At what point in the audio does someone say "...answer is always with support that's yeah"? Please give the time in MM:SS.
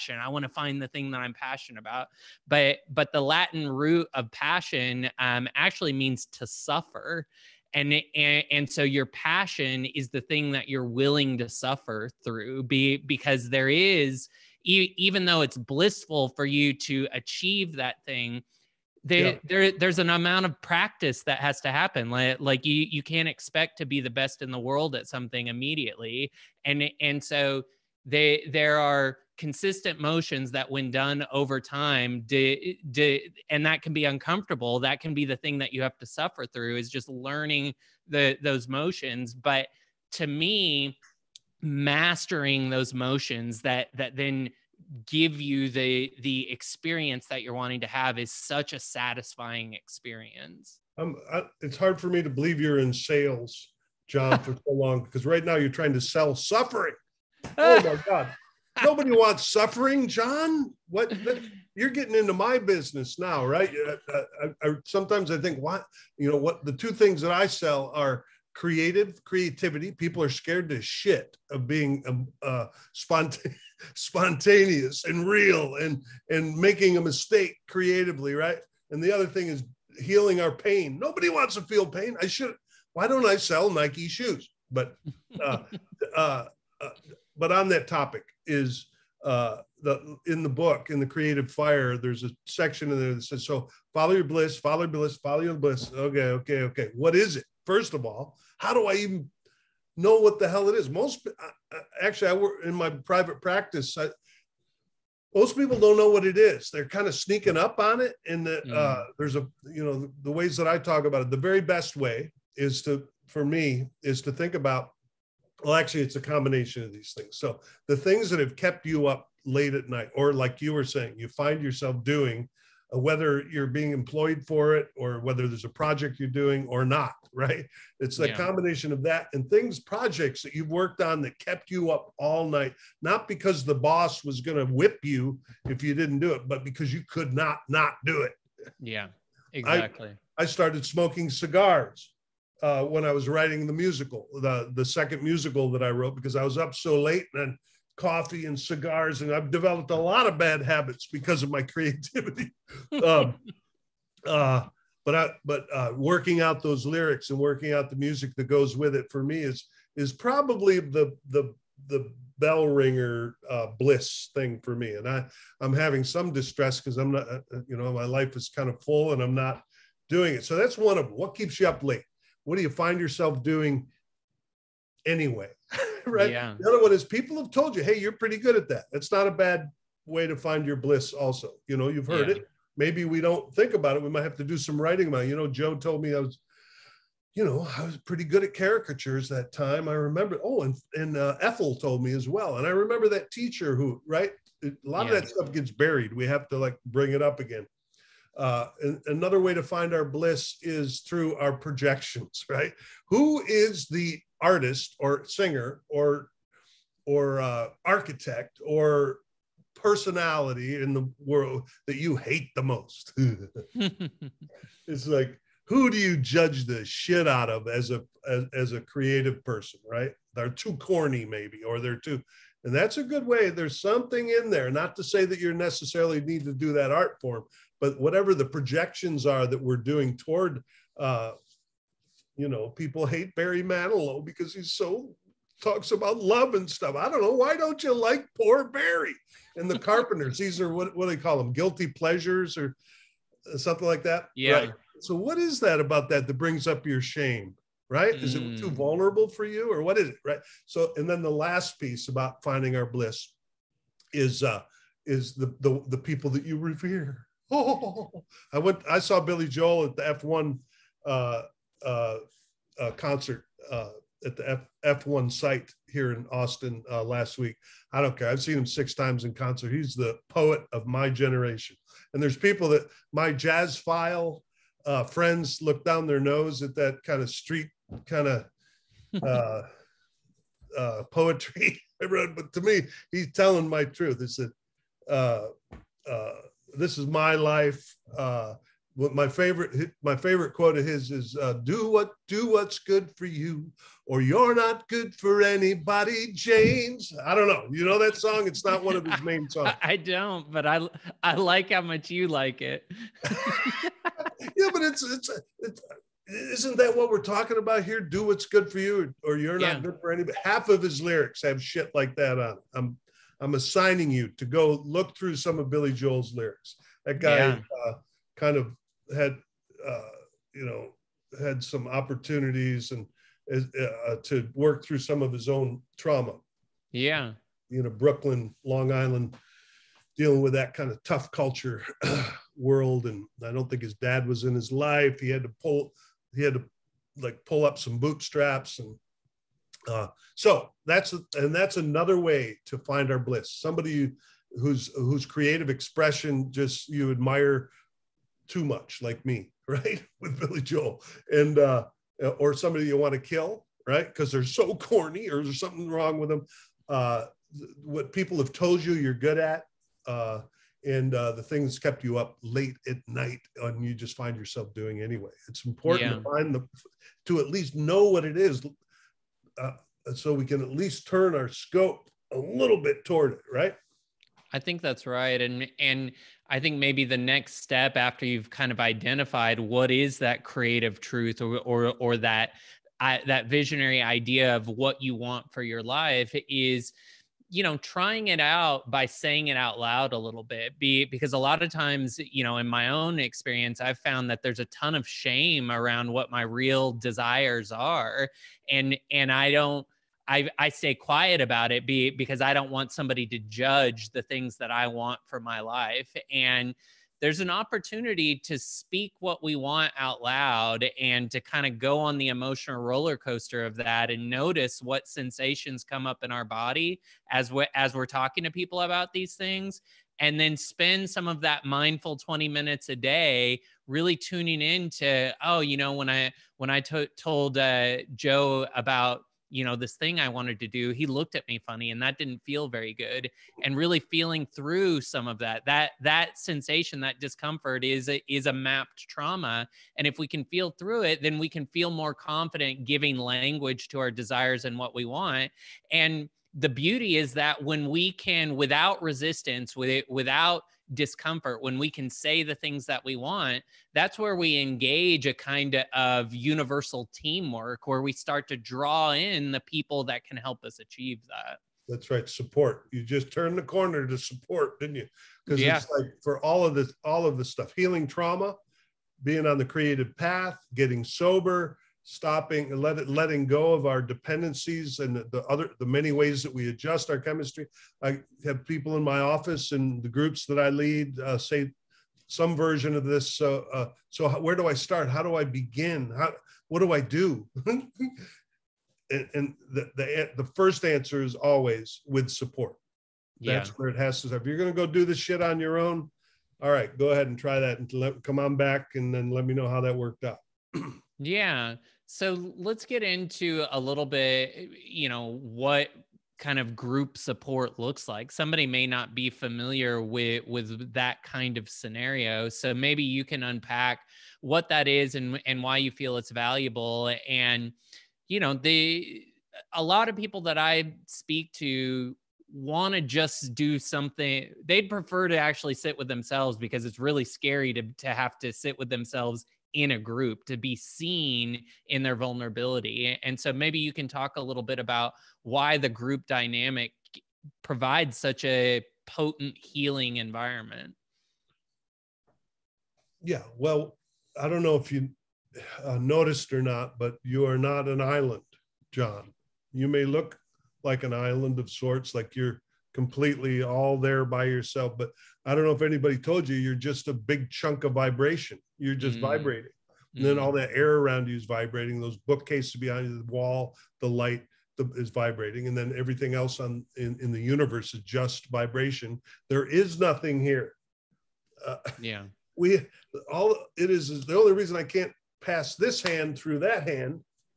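08:10.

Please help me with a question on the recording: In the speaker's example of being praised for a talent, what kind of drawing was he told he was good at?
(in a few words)
caricatures.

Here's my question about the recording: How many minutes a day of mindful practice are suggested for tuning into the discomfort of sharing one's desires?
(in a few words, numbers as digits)
20.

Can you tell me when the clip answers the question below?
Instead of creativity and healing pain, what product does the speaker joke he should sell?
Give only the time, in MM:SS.
01:23.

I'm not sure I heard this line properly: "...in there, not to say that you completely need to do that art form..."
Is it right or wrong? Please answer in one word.
wrong.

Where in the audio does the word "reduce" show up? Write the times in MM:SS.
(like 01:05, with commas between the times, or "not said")
not said.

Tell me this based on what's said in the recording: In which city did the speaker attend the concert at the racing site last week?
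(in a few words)
Austin.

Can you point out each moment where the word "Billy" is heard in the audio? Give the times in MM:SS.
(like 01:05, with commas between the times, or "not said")
04:19, 05:15, 05:50.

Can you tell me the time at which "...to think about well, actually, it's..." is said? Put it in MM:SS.
01:54.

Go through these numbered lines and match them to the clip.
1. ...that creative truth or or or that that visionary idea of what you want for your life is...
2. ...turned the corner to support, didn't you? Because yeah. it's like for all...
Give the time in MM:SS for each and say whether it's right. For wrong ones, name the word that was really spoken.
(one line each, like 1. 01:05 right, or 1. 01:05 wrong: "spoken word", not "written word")
1. 06:20 right
2. 07:43 right.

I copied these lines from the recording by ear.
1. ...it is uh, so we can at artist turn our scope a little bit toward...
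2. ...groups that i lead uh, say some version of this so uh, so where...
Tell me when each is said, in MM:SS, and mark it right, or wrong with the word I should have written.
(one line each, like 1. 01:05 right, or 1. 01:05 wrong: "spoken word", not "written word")
1. 06:08 wrong: "least", not "artist"
2. 08:00 right.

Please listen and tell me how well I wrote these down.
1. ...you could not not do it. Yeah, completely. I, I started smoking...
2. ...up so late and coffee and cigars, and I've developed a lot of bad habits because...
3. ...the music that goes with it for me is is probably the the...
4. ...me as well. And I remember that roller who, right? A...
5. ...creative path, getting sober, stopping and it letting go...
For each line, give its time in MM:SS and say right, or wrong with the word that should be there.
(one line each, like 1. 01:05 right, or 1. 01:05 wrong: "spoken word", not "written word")
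1. 02:16 wrong: "exactly", not "completely"
2. 02:26 right
3. 02:37 right
4. 03:12 wrong: "teacher", not "roller"
5. 07:49 right.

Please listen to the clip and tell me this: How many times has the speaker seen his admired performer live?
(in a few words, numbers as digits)
6.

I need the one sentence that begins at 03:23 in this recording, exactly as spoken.
Who is the artist or singer or or uh, architect or personality in the world that you hate the most?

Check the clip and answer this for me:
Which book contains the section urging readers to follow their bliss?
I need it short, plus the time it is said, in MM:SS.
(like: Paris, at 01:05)
The Creative Fire, at 01:30.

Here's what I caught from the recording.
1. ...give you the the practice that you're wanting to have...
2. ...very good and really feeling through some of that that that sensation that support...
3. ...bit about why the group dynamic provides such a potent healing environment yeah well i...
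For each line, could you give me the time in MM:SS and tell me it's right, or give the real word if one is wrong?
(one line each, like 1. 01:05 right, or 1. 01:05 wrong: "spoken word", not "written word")
1. 00:45 wrong: "experience", not "practice"
2. 07:12 wrong: "discomfort", not "support"
3. 08:54 right.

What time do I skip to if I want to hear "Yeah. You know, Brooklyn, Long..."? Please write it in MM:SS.
05:26.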